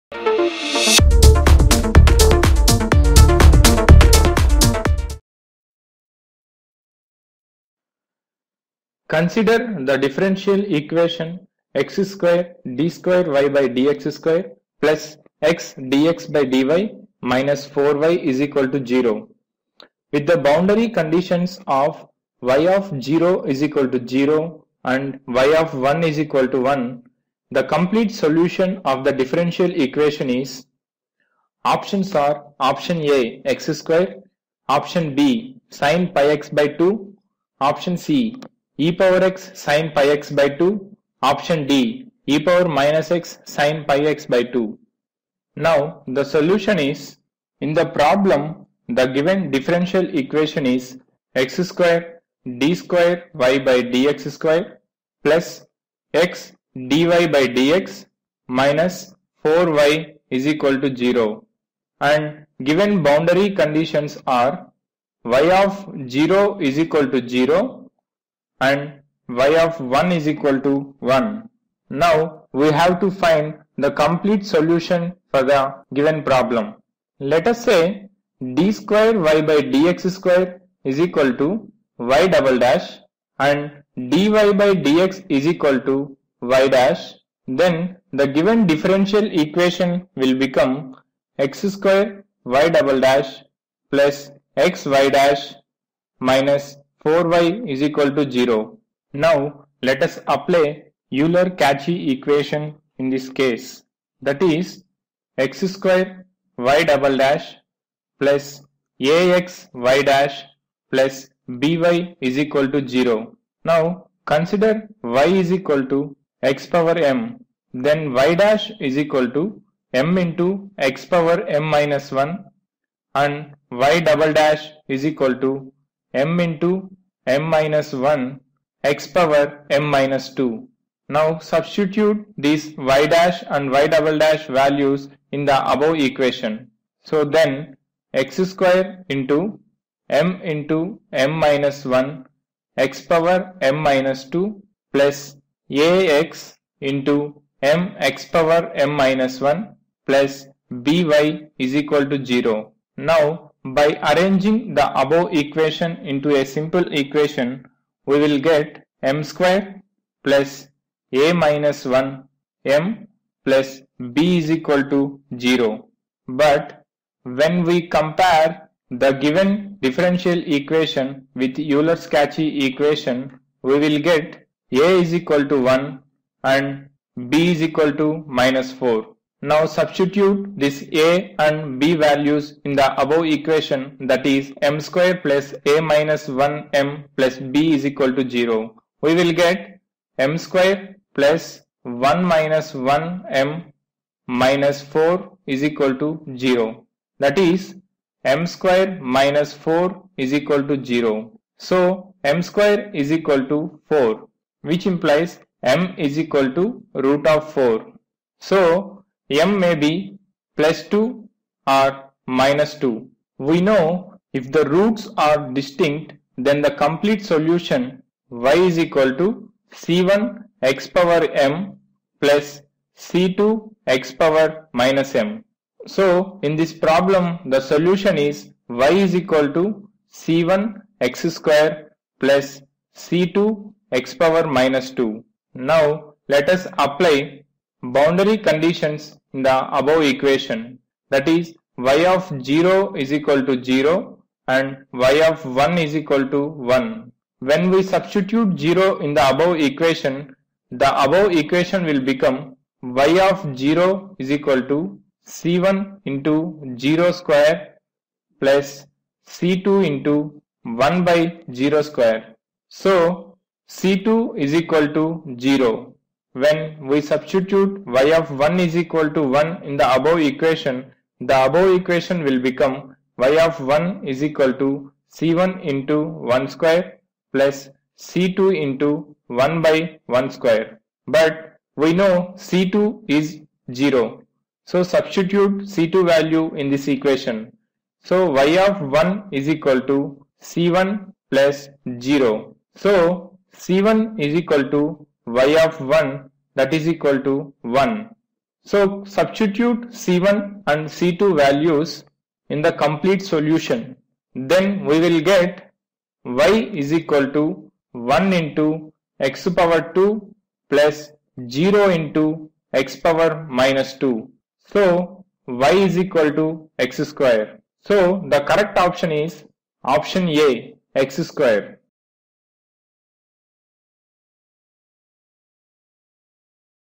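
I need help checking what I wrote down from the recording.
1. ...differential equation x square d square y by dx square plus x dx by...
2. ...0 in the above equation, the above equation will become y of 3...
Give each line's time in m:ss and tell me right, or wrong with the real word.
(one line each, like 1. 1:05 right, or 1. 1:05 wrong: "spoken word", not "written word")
1. 0:09 right
2. 4:08 wrong: "0", not "3".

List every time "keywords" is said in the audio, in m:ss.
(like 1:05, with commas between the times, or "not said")
not said.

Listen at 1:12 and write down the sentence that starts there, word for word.
Now we have to find the complete solution for the given problem.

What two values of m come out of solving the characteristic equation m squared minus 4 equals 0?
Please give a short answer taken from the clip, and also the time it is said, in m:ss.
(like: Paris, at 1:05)
2 or -2, at 3:30.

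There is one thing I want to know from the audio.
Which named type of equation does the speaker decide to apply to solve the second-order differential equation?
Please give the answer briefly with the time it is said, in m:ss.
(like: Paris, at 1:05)
Euler-Cauchy equation, at 1:41.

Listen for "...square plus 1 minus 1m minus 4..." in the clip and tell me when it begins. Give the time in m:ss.
3:10.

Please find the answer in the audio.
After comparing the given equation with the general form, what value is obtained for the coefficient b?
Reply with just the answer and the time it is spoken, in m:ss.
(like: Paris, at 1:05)
-4, at 2:57.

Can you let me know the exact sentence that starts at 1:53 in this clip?
Now consider y is equal to x power m.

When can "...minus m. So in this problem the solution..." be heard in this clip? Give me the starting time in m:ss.
3:44.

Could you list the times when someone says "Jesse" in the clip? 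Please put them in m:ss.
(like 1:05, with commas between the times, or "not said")
not said.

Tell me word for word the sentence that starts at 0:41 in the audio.
Option D e power minus x sine pi x by 2.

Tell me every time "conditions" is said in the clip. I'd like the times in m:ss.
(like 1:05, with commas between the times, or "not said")
0:20, 1:03, 3:58.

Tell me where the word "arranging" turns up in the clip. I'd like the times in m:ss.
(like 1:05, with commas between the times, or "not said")
2:34.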